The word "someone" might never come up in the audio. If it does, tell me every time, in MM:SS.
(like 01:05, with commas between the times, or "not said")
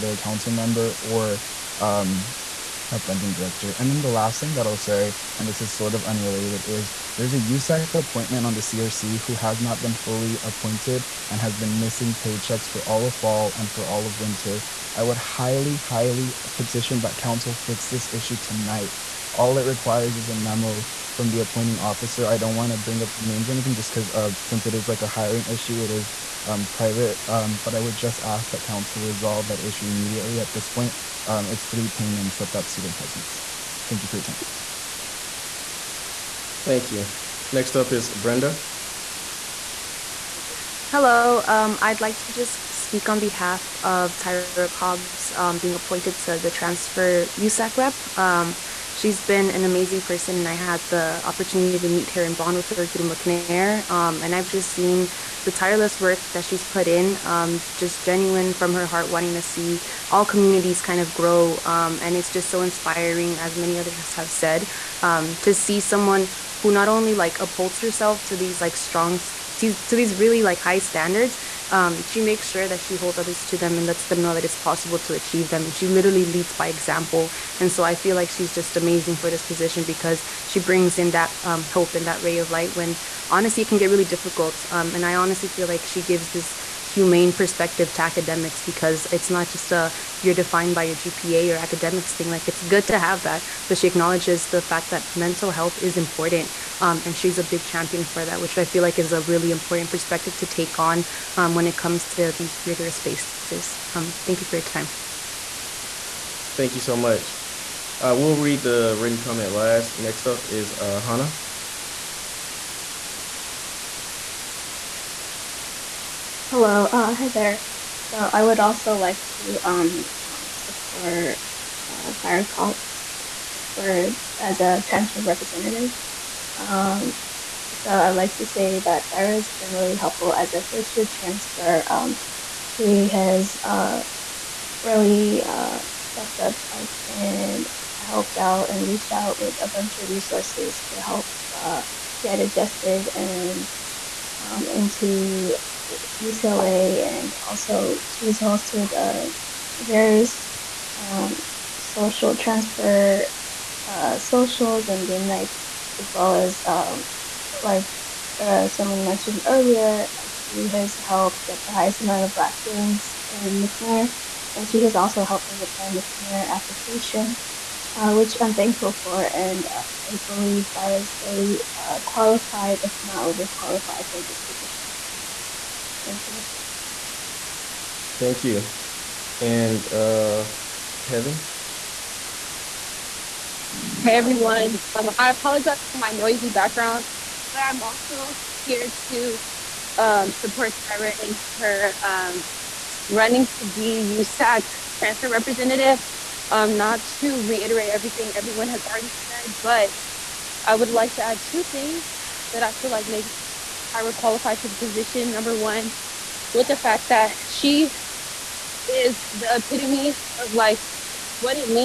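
01:05, 02:38.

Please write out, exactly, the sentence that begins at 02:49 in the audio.
And uh, I believe Tyra is fully uh, qualified, if not overqualified, for this position.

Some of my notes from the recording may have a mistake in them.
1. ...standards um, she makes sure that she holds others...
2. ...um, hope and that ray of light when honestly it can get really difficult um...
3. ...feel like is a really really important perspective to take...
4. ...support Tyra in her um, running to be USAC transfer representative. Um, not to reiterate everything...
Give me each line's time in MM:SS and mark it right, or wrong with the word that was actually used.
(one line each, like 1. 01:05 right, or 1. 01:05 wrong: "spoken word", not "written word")
1. 01:10 right
2. 01:21 right
3. 01:38 right
4. 03:10 right.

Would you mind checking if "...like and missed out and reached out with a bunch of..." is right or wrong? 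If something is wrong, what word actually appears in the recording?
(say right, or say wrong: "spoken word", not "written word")
wrong: "helped", not "missed".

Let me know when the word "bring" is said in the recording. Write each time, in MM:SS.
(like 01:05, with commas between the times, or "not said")
00:22, 01:20.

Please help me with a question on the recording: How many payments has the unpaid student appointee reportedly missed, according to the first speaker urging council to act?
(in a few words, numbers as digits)
3.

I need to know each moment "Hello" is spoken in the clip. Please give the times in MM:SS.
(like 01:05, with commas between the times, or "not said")
00:40, 01:56.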